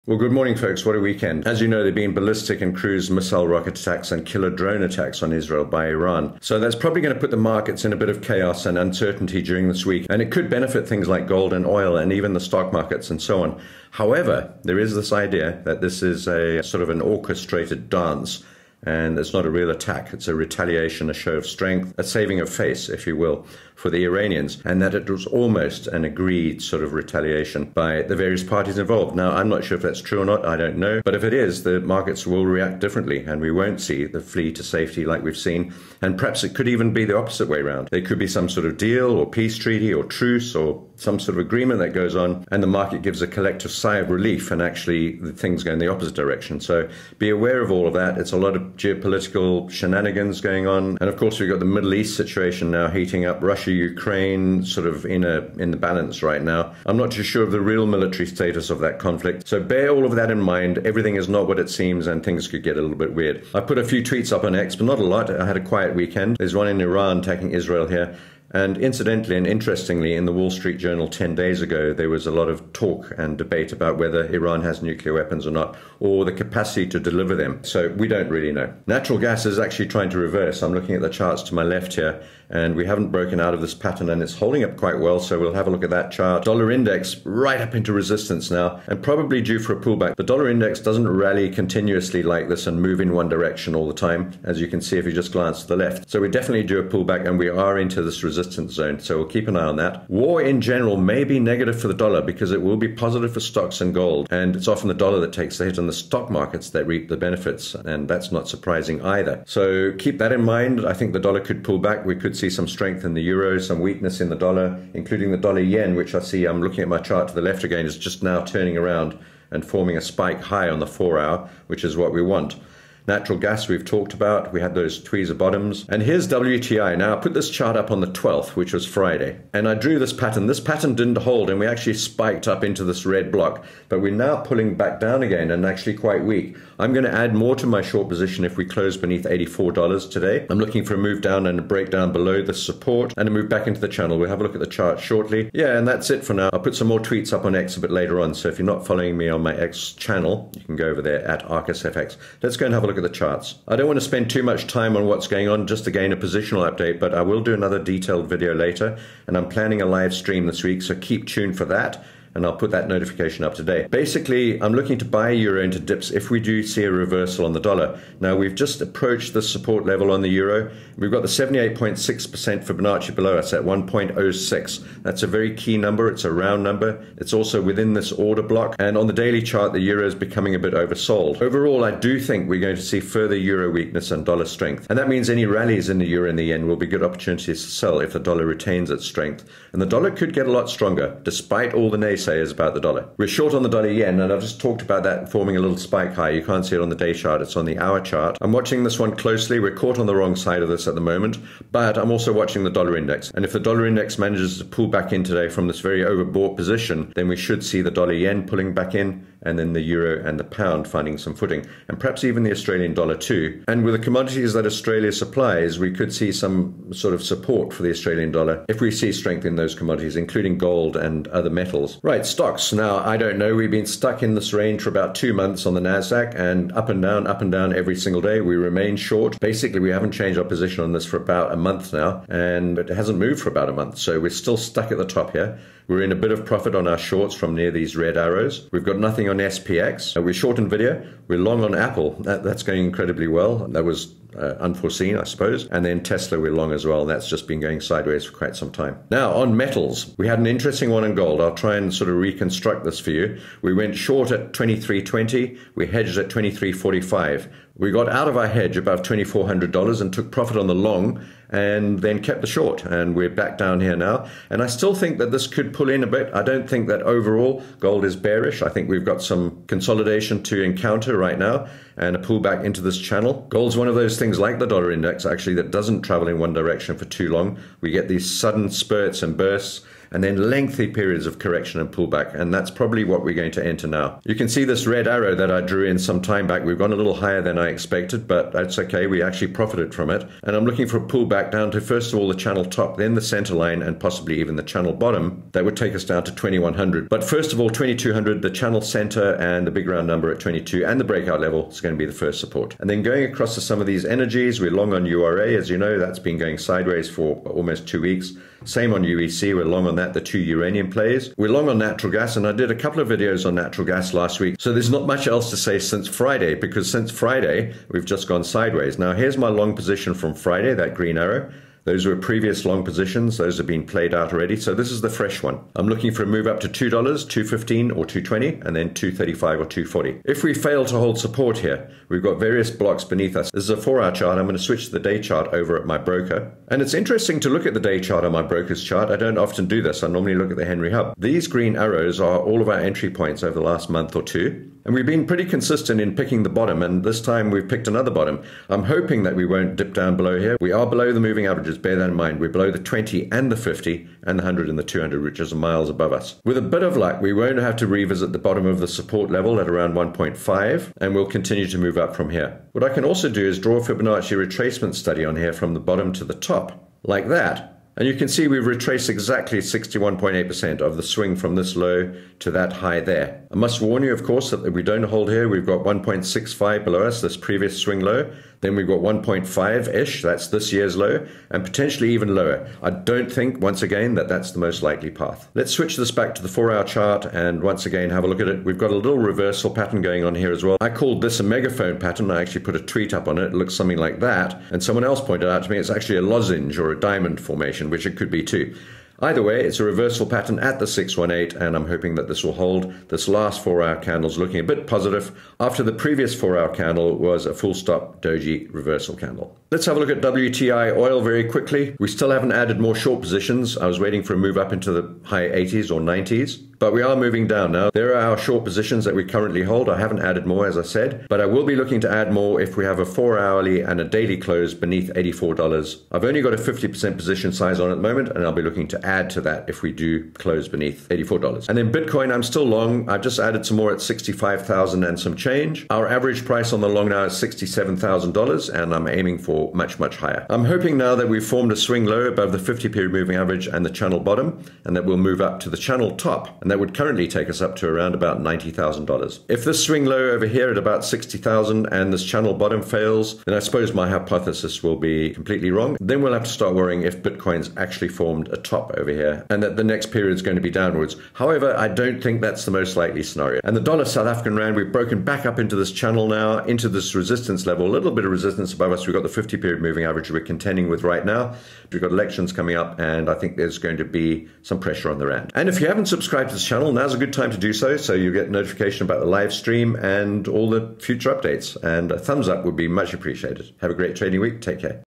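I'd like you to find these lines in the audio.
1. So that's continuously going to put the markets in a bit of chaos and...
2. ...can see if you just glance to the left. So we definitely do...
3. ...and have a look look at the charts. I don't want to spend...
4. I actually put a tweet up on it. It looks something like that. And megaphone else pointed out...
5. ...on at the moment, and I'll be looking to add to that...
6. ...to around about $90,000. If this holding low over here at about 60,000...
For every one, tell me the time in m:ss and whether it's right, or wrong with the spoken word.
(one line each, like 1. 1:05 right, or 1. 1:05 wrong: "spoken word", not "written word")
1. 0:06 wrong: "probably", not "continuously"
2. 1:34 right
3. 2:32 right
4. 6:32 wrong: "someone", not "megaphone"
5. 7:07 right
6. 7:27 wrong: "swing", not "holding".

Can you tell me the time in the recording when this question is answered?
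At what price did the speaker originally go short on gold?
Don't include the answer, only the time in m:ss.
4:14.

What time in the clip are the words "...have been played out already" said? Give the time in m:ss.
5:23.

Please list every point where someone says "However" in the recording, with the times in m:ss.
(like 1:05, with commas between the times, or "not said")
0:13, 7:41.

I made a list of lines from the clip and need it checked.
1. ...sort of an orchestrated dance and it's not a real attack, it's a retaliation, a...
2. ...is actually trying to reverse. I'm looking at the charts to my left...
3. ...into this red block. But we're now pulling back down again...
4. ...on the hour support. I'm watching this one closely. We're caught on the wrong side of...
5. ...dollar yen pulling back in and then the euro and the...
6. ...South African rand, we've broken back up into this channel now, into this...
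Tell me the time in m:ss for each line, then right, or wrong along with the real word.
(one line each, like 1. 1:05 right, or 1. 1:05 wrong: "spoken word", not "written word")
1. 0:16 right
2. 1:19 right
3. 2:12 right
4. 3:17 wrong: "chart", not "support"
5. 3:27 right
6. 7:44 right.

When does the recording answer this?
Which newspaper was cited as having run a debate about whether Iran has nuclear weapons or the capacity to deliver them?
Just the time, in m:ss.
1:10.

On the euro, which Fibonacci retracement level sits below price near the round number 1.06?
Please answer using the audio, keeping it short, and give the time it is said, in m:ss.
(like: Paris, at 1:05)
78.6%, at 2:51.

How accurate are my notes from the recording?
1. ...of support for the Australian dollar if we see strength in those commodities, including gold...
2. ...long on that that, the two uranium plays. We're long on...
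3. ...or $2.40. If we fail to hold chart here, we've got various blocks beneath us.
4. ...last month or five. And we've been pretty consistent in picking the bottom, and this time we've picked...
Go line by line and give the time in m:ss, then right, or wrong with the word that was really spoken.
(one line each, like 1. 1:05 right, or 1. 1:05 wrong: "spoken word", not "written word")
1. 3:37 right
2. 5:09 right
3. 5:29 wrong: "support", not "chart"
4. 5:43 wrong: "two", not "five".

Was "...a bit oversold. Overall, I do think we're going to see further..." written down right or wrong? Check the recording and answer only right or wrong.
right.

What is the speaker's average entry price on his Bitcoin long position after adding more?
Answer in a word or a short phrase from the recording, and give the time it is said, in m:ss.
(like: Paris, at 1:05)
$67,000, at 7:17.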